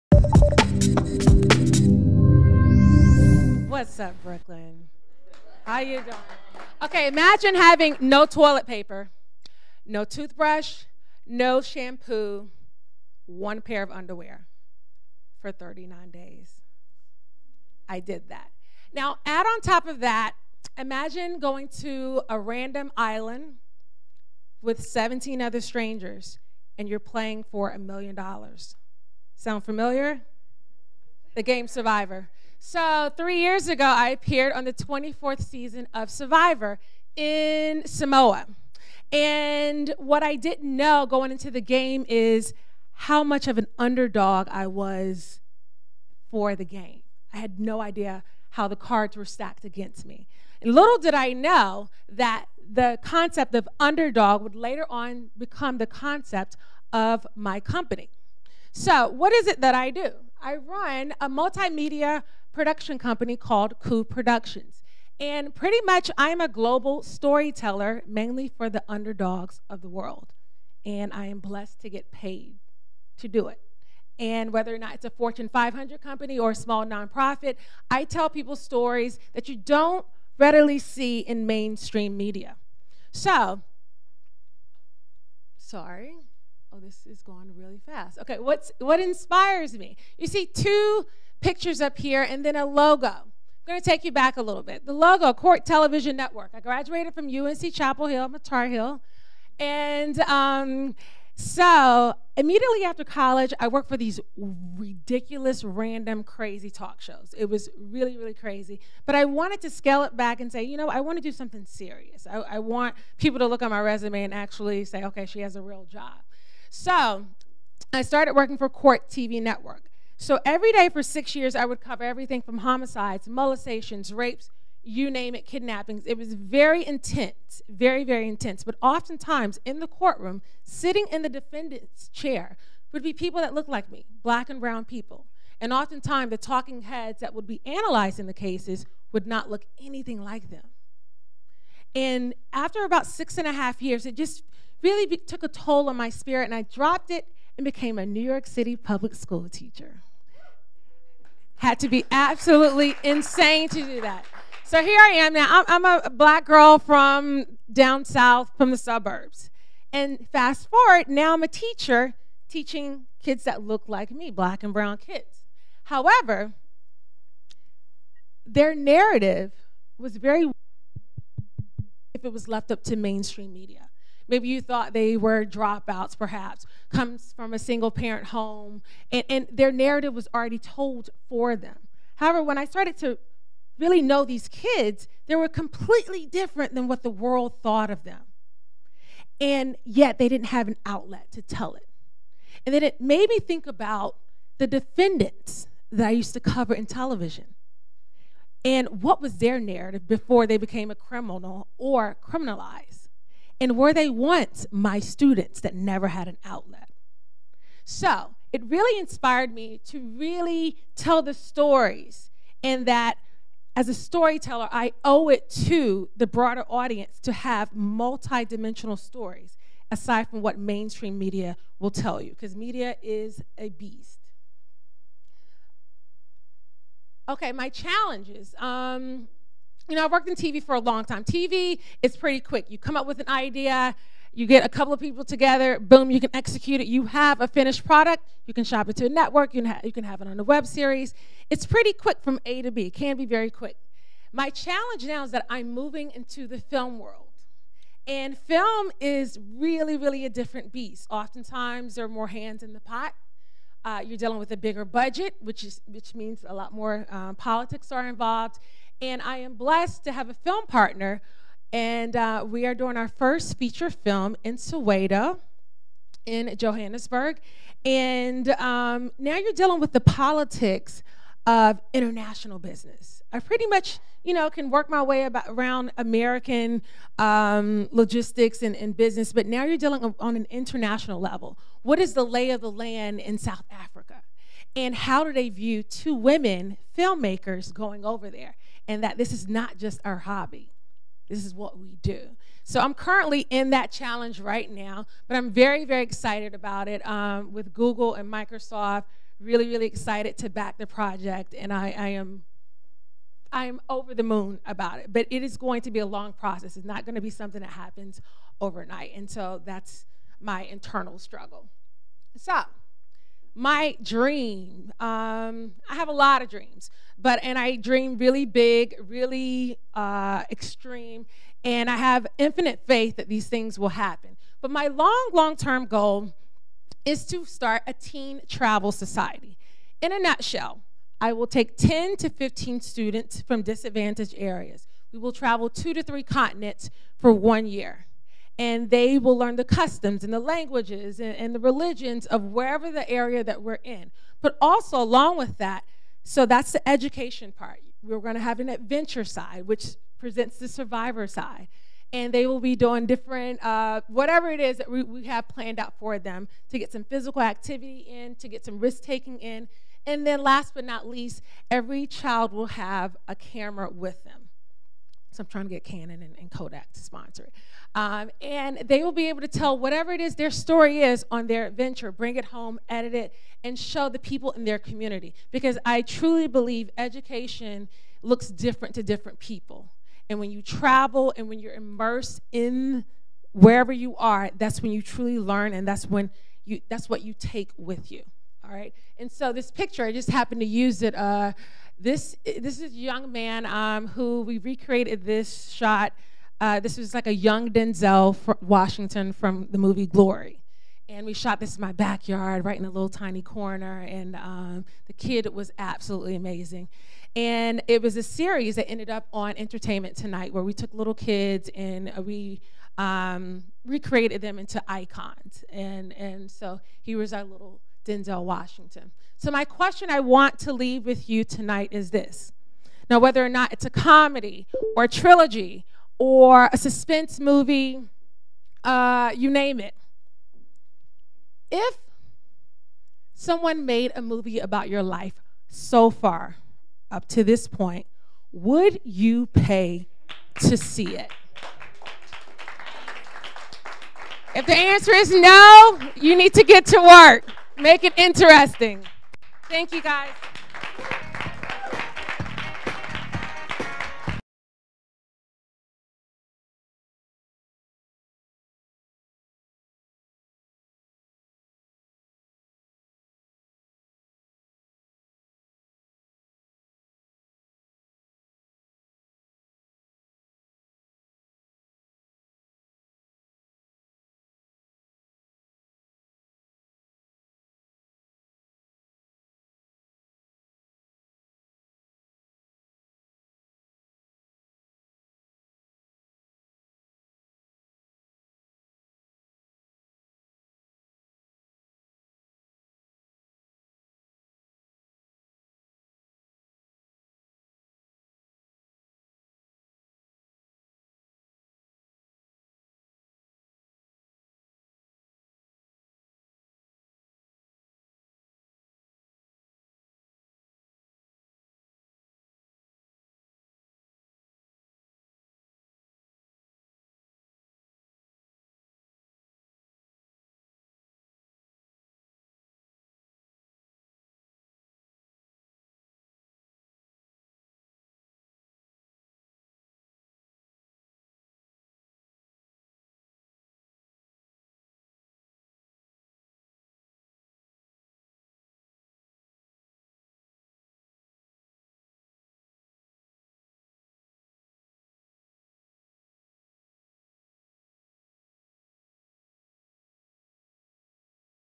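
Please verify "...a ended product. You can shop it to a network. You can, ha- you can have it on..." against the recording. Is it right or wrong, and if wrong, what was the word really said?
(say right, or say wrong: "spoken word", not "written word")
wrong: "finished", not "ended".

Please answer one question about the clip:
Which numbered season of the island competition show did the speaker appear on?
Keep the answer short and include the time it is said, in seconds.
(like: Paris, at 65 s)
24th, at 34 s.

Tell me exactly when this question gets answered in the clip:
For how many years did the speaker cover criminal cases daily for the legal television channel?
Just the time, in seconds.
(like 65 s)
121 s.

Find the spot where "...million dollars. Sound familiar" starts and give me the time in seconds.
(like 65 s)
27 s.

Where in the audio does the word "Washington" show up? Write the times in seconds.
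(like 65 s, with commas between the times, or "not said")
398 s, 418 s.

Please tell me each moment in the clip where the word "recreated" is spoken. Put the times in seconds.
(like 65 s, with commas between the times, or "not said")
394 s, 413 s.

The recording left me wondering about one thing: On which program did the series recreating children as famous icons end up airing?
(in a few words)
Entertainment Tonight.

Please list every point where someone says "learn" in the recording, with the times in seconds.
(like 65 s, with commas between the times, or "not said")
339 s, 385 s.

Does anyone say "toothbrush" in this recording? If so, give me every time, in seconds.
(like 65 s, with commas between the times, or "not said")
10 s.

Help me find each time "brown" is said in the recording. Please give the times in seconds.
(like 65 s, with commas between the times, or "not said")
134 s, 164 s.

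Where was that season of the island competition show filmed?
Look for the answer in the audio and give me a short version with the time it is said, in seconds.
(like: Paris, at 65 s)
Samoa, at 37 s.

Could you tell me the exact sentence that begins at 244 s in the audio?
My challenge now is that I'm moving into the film world.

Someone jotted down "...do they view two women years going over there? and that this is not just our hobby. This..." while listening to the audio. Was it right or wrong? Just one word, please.
wrong.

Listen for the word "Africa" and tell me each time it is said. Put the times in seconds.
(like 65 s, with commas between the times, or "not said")
283 s.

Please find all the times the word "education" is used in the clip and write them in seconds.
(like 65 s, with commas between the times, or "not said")
346 s, 376 s.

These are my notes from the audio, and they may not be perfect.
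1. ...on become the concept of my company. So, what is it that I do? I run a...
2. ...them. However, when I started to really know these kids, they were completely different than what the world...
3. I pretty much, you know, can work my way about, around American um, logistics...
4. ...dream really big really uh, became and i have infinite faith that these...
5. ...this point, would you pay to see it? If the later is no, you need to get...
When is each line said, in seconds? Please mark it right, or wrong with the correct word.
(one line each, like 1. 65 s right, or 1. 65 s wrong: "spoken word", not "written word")
1. 54 s right
2. 181 s right
3. 273 s right
4. 317 s wrong: "extreme", not "became"
5. 437 s wrong: "answer", not "later".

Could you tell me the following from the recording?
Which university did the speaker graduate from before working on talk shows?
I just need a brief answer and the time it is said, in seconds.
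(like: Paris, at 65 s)
UNC Chapel Hill, at 97 s.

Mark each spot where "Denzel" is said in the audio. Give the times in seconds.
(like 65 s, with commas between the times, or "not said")
397 s, 418 s.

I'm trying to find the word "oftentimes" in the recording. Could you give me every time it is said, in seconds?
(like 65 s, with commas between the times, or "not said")
128 s, 135 s, 251 s.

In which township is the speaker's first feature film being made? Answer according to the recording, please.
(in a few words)
Soweto.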